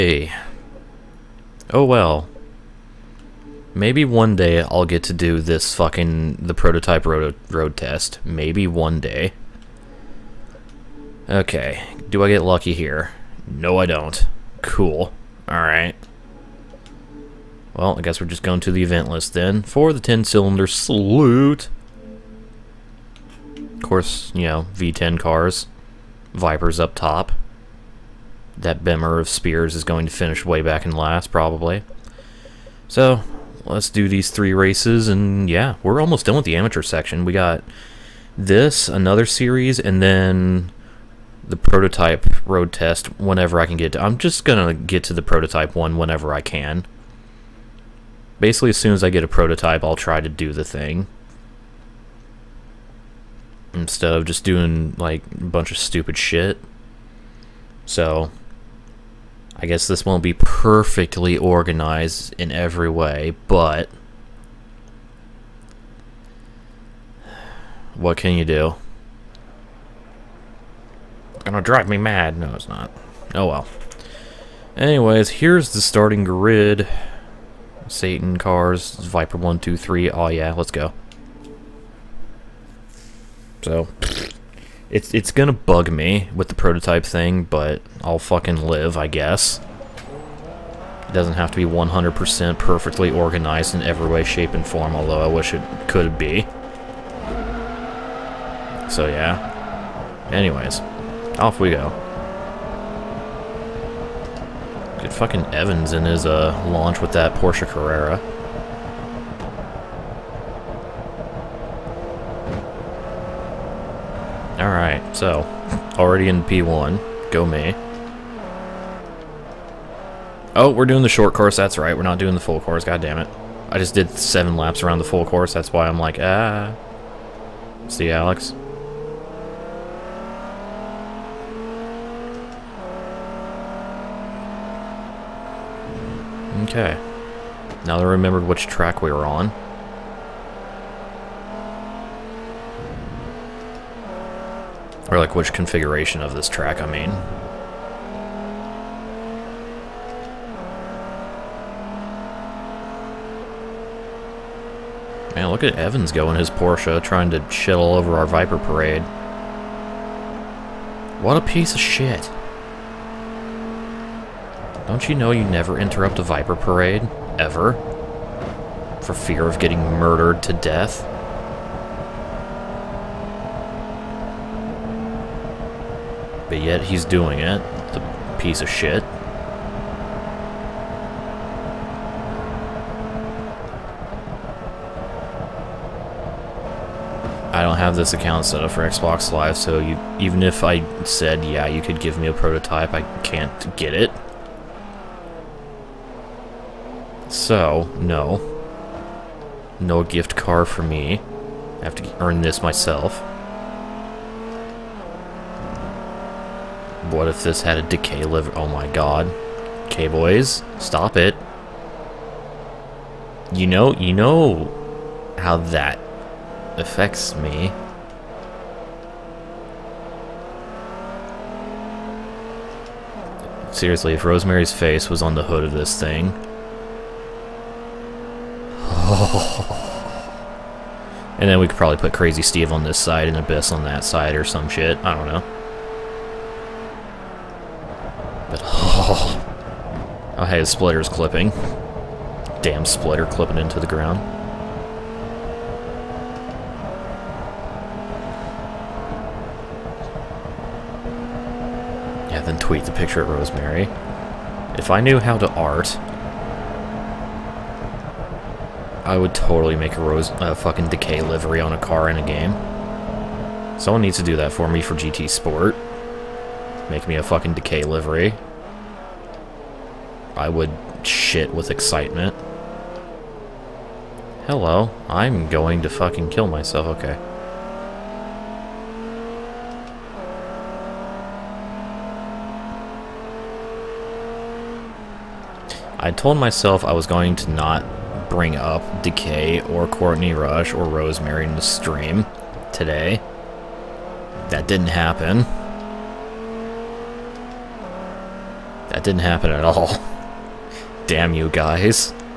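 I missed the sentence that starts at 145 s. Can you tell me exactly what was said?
Or like which configuration of this track, I mean.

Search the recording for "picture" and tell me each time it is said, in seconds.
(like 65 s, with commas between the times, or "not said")
252 s.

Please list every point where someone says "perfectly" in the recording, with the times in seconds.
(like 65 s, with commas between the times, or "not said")
60 s, 92 s.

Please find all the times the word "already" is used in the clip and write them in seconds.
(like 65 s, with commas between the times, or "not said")
115 s.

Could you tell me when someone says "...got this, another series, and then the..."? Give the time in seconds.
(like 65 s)
37 s.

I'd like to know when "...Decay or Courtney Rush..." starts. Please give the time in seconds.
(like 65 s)
289 s.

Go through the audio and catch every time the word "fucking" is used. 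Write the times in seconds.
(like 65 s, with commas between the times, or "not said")
5 s, 88 s, 105 s, 260 s, 267 s, 275 s.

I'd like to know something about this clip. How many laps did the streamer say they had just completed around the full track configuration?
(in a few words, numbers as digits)
7.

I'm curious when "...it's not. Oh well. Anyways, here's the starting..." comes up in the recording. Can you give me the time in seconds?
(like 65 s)
72 s.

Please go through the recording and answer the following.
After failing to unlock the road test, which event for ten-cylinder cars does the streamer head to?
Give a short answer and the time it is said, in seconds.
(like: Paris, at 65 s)
10-cylinder salute, at 20 s.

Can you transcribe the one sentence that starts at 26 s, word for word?
Vipers up top that Bimmer of Spears is going to finish way back in last, probably.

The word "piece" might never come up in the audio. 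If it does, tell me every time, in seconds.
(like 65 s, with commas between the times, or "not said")
161 s, 178 s.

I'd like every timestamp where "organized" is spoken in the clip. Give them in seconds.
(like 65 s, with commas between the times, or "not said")
61 s, 93 s.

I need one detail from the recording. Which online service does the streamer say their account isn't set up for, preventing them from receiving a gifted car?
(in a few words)
Xbox Live.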